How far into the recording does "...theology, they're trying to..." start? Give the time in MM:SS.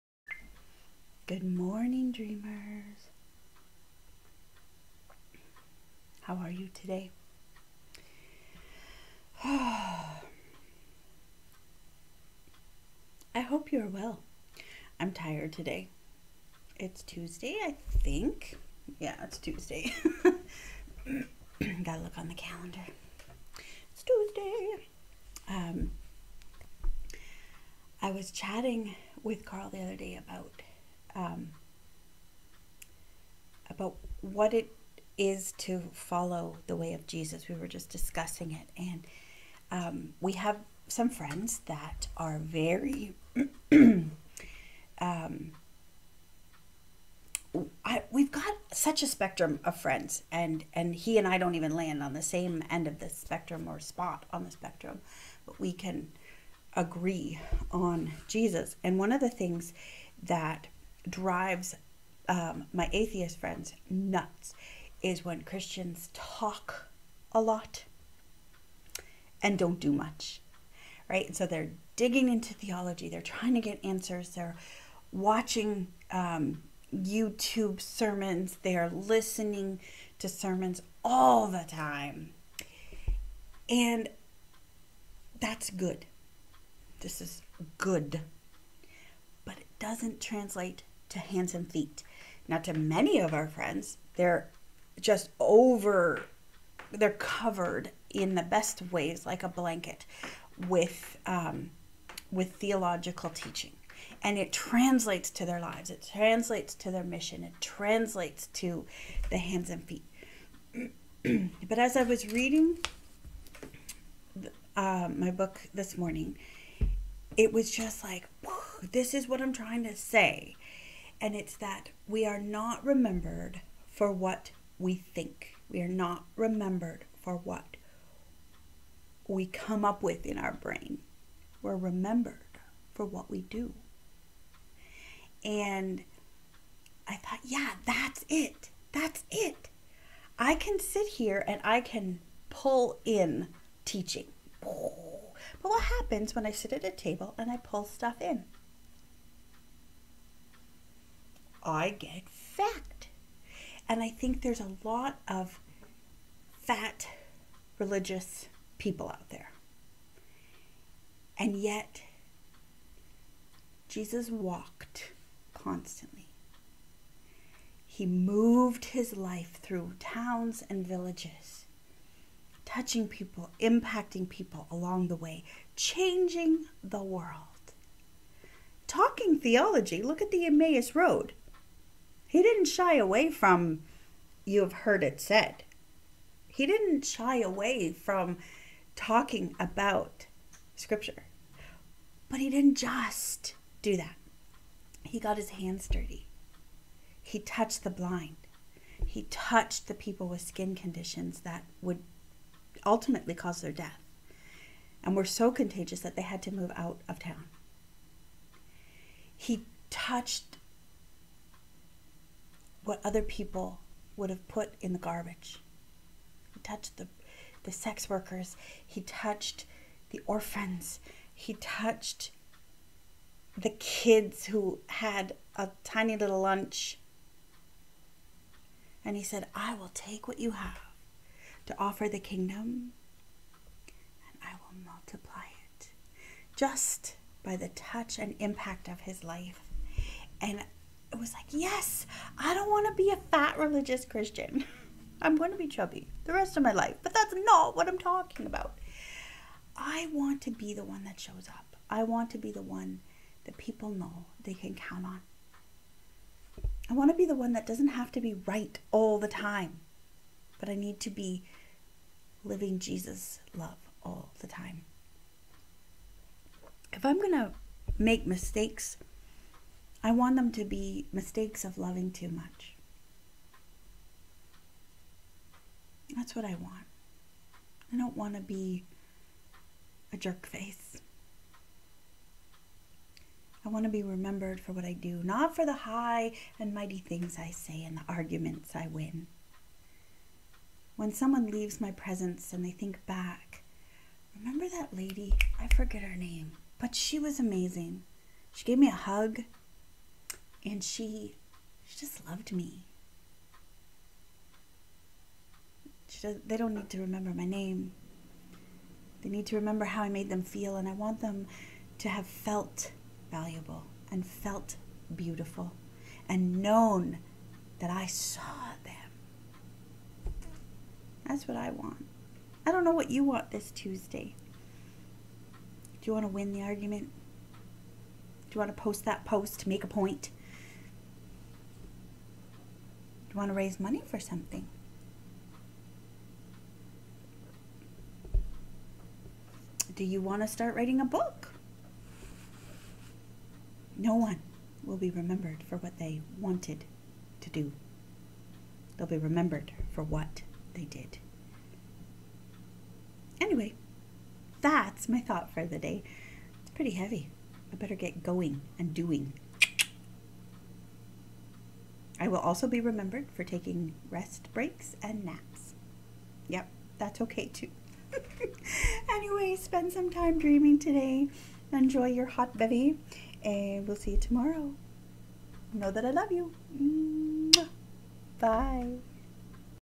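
01:12.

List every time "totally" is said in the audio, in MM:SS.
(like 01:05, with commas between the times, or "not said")
not said.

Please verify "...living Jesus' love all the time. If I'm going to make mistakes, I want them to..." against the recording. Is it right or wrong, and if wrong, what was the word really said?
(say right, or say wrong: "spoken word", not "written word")
right.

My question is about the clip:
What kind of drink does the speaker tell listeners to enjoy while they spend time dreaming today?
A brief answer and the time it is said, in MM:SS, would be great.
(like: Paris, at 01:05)
hot bevy, at 06:12.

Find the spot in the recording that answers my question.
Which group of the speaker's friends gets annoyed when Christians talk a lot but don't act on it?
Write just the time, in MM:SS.
01:02.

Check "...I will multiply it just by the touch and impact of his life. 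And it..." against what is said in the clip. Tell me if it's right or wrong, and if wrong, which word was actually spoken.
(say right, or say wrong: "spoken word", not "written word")
right.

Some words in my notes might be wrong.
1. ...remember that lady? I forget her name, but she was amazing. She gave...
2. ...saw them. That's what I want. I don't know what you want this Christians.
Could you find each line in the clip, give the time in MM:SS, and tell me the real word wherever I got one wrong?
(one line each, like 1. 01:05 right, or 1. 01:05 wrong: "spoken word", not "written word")
1. 04:54 right
2. 05:18 wrong: "Tuesday", not "Christians".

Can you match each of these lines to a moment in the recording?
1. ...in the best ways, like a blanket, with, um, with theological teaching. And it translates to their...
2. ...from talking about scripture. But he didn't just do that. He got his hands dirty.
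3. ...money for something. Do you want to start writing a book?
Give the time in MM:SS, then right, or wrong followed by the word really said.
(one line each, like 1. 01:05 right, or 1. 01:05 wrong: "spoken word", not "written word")
1. 01:38 right
2. 03:07 right
3. 05:33 right.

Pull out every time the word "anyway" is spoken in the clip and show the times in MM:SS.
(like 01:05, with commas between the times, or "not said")
05:53, 06:09.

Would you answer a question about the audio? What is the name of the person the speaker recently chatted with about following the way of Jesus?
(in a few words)
Carl.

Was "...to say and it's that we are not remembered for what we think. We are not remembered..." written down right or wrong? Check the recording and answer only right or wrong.
right.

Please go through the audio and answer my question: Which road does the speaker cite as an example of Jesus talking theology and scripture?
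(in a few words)
Emmaus Road.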